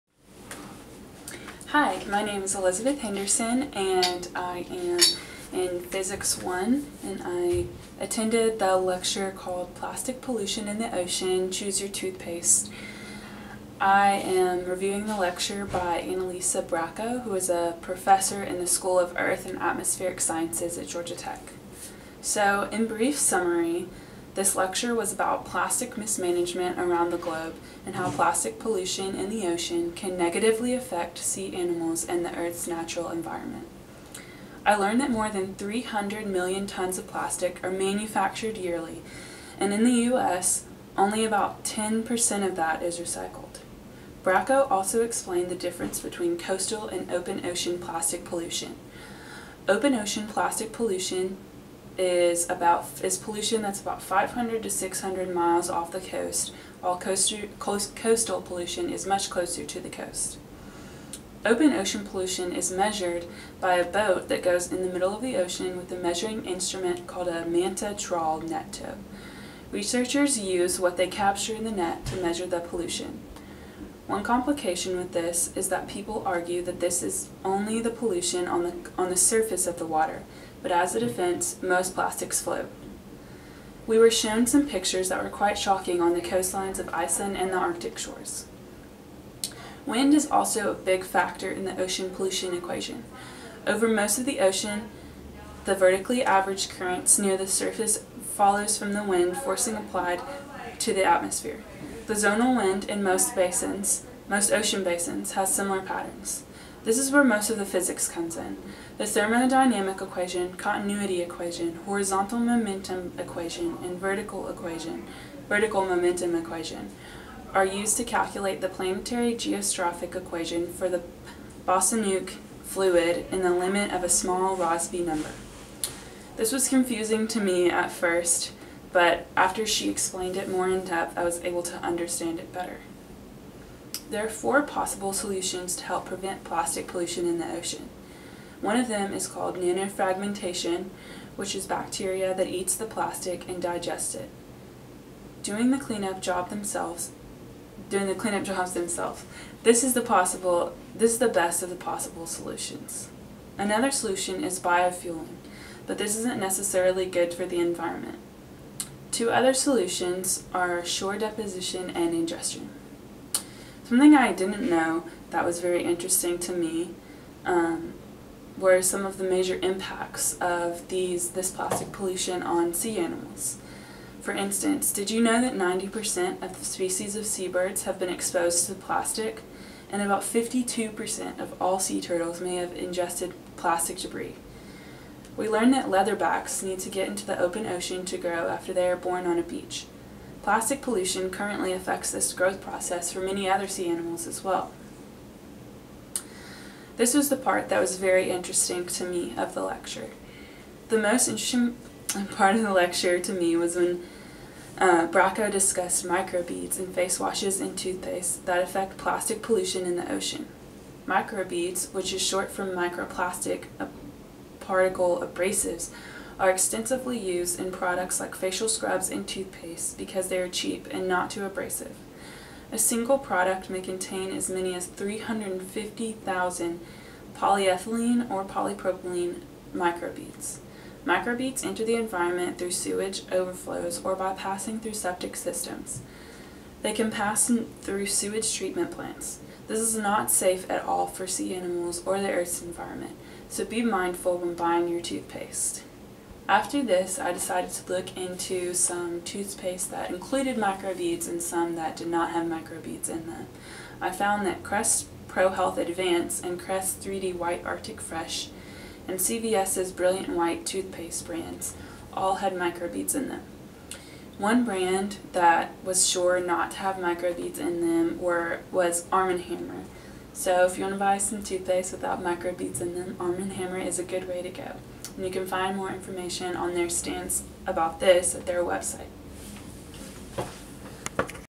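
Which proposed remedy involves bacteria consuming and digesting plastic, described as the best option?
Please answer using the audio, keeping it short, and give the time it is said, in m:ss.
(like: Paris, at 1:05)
nanofragmentation, at 2:19.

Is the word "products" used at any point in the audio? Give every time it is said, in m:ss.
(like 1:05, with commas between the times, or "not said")
3:37, 3:43.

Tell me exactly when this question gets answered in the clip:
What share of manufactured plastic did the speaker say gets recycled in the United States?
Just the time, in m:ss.
0:41.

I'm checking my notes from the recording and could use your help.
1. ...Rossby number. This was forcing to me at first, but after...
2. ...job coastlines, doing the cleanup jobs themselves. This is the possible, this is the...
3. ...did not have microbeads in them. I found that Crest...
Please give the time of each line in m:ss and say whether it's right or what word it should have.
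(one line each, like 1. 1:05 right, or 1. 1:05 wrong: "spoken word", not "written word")
1. 2:04 wrong: "confusing", not "forcing"
2. 2:26 wrong: "themselves", not "coastlines"
3. 4:11 right.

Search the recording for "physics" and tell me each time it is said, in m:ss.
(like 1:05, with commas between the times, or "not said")
0:05, 1:47.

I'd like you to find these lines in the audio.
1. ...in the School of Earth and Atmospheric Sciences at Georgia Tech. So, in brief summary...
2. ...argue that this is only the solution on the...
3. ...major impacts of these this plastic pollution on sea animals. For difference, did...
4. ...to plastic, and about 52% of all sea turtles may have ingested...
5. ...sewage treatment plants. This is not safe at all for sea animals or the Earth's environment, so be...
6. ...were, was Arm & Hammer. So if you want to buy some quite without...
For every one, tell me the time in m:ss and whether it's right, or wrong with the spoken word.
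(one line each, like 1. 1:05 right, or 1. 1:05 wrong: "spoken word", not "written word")
1. 0:18 right
2. 1:16 wrong: "pollution", not "solution"
3. 2:49 wrong: "instance", not "difference"
4. 2:58 right
5. 3:58 right
6. 4:28 wrong: "toothpaste", not "quite".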